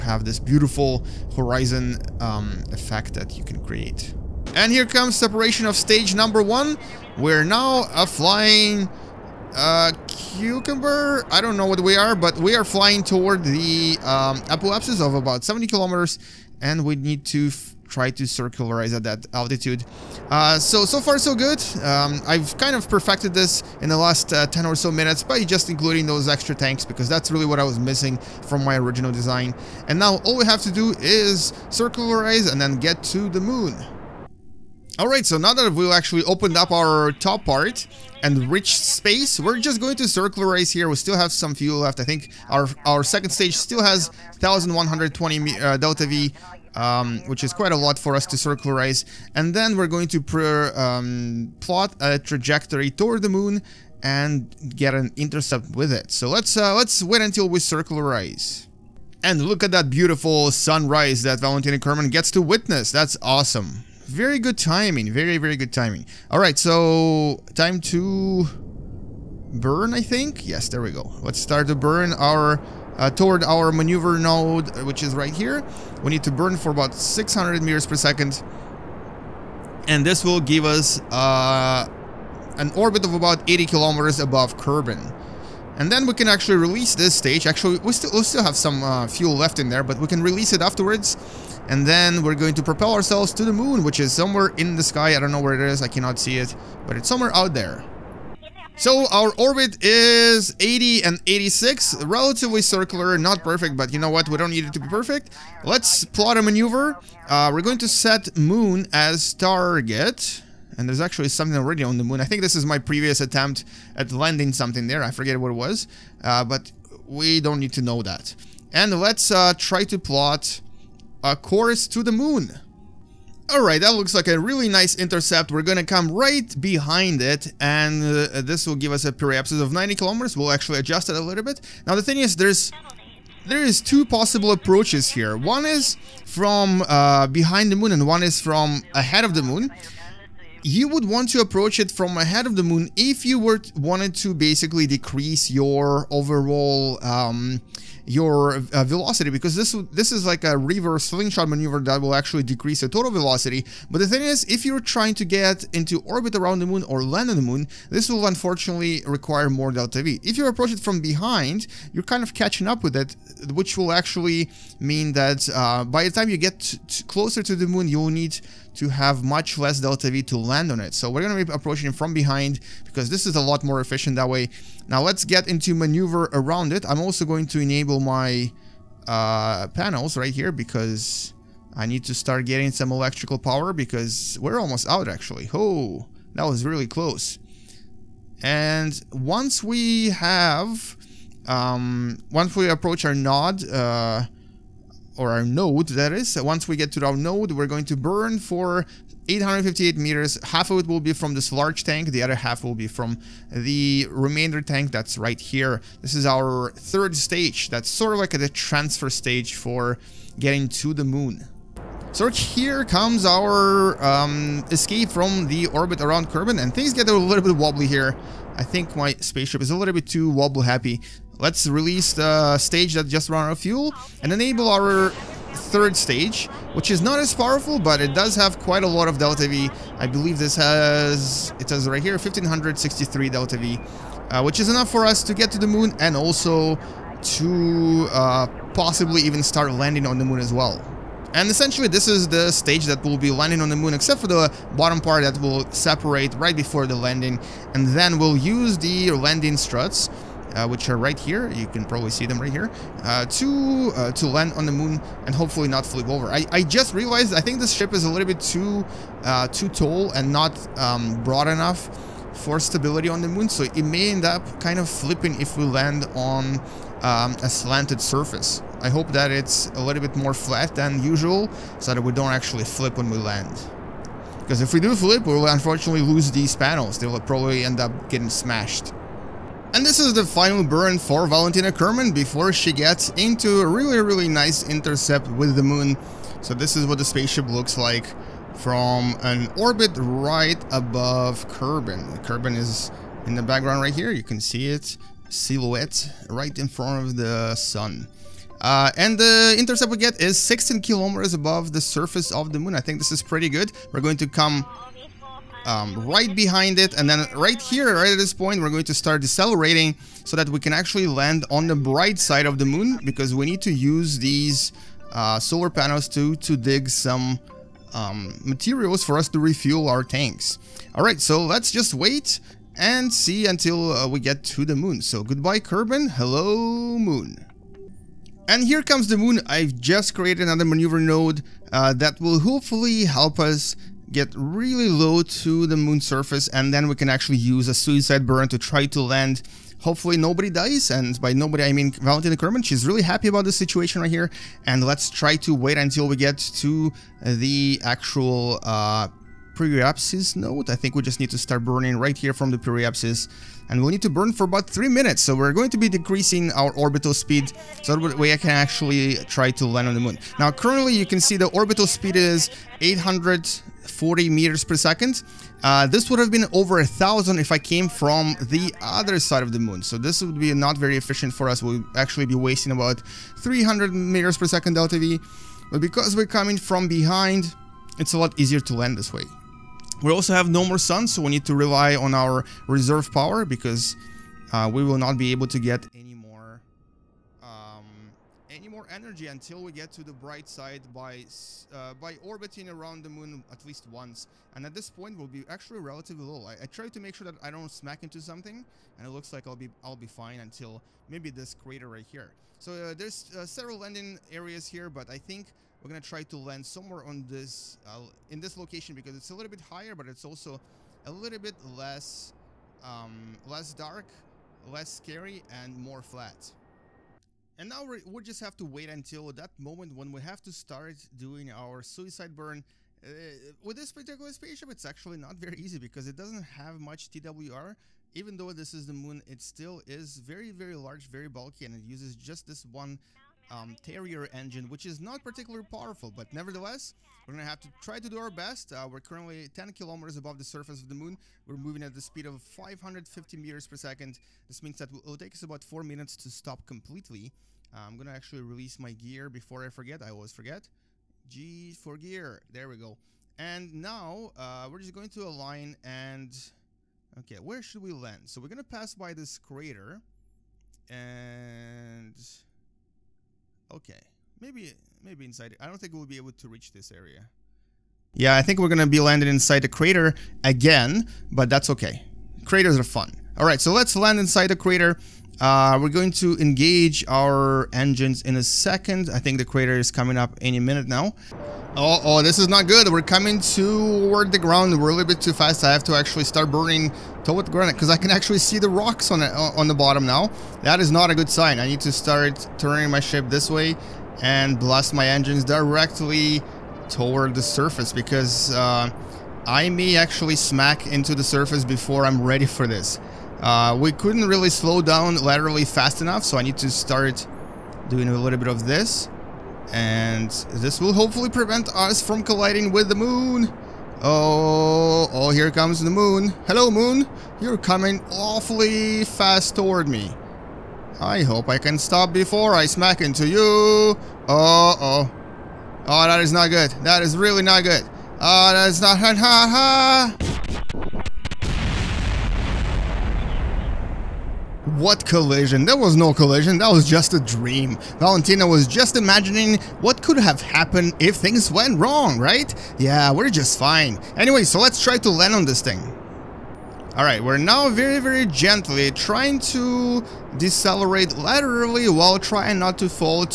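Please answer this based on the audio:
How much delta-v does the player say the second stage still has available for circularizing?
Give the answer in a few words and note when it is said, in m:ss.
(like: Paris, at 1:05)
1120, at 0:44.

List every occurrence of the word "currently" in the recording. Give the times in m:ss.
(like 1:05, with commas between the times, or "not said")
6:00, 7:19.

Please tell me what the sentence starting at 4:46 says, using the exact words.
So this is what the spaceship looks like from an orbit right above Kerbin.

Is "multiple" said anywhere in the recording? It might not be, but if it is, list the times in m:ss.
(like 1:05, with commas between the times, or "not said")
not said.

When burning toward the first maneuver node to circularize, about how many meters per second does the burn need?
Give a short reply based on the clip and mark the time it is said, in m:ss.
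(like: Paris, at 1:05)
600 meters per second, at 1:16.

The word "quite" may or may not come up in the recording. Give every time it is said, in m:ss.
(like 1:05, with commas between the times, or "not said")
0:47, 3:48.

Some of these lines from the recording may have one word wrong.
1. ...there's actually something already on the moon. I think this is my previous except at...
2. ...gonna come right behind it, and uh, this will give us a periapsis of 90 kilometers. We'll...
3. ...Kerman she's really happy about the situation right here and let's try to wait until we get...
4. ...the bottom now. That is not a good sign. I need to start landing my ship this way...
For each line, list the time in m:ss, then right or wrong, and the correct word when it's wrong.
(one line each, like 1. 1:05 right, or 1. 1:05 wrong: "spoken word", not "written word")
1. 1:50 wrong: "attempt", not "except"
2. 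2:05 right
3. 5:42 right
4. 8:09 wrong: "turning", not "landing".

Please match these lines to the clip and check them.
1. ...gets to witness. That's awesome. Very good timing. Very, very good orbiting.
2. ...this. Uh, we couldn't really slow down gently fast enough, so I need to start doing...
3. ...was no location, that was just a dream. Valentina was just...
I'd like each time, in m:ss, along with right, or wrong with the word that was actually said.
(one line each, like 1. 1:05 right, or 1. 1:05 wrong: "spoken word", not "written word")
1. 1:02 wrong: "timing", not "orbiting"
2. 8:22 wrong: "laterally", not "gently"
3. 8:55 wrong: "collision", not "location".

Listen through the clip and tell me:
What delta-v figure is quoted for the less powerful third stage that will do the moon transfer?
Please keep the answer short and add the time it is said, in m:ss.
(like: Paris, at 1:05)
1563, at 3:52.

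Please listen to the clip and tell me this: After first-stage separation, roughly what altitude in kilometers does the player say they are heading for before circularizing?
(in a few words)
70 kilometers.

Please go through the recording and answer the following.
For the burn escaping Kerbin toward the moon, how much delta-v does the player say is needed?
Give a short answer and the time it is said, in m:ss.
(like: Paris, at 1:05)
858, at 3:19.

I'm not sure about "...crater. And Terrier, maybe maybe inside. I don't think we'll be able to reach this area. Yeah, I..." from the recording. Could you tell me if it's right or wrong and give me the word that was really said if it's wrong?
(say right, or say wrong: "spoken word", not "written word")
wrong: "Okay", not "Terrier".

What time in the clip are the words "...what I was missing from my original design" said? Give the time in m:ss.
0:27.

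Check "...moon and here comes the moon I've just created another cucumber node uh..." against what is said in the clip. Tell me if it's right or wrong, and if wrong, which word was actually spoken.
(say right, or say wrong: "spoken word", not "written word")
wrong: "maneuver", not "cucumber".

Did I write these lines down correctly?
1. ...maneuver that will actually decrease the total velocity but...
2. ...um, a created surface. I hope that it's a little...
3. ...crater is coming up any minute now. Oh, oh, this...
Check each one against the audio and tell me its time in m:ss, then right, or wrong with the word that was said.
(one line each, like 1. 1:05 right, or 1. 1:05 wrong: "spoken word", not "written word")
1. 2:31 right
2. 4:27 wrong: "slanted", not "created"
3. 7:59 right.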